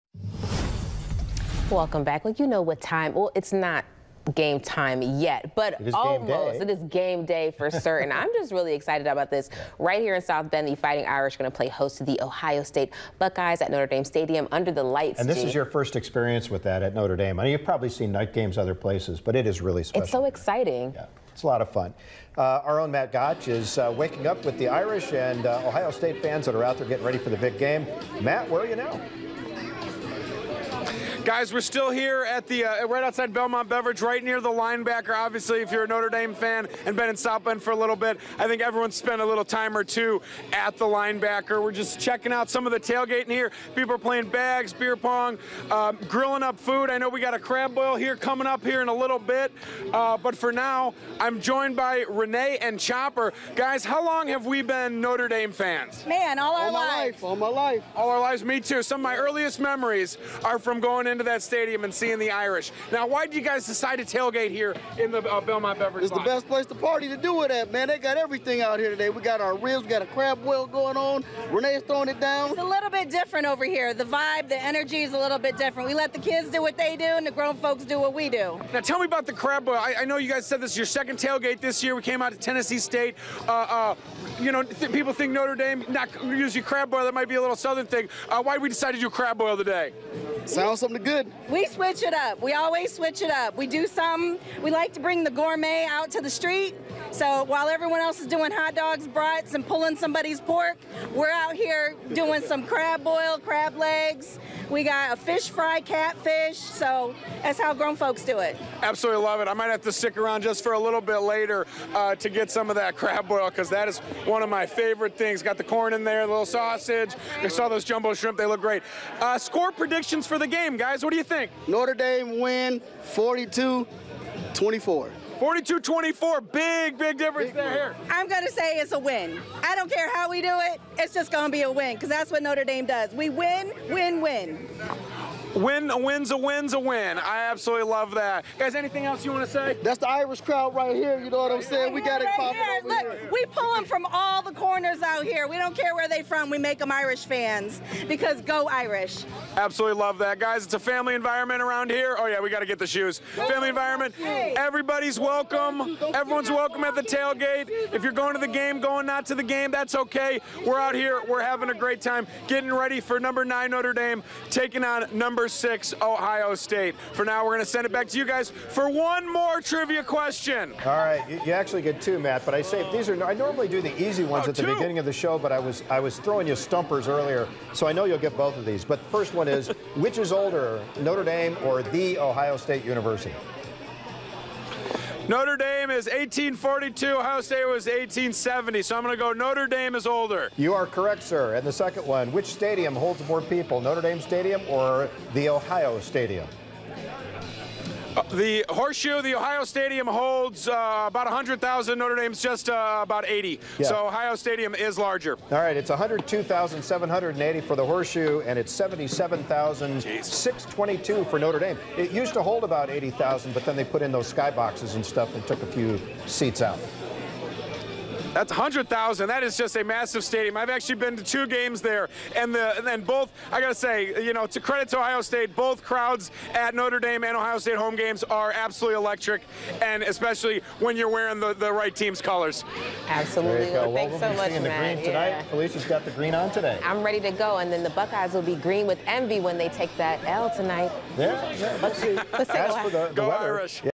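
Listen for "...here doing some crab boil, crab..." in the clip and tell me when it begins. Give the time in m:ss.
1:41.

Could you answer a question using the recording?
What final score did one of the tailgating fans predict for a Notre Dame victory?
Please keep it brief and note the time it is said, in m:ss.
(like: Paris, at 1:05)
42-24, at 2:03.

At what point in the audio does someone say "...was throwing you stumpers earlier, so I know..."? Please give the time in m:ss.
2:55.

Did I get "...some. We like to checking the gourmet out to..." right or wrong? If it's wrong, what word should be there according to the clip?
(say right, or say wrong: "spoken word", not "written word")
wrong: "bring", not "checking".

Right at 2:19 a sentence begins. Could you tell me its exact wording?
That's the Irish crowd right here.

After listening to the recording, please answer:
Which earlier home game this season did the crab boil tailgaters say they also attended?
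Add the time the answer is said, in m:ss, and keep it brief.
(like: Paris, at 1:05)
Tennessee State, at 1:22.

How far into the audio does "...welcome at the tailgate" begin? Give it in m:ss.
2:36.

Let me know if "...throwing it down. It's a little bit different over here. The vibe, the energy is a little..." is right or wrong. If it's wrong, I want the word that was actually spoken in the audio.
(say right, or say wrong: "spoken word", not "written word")
right.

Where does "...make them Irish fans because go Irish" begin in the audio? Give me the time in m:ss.
2:26.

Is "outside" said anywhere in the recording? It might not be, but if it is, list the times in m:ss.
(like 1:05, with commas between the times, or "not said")
0:33.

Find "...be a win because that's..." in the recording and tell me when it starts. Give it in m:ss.
2:11.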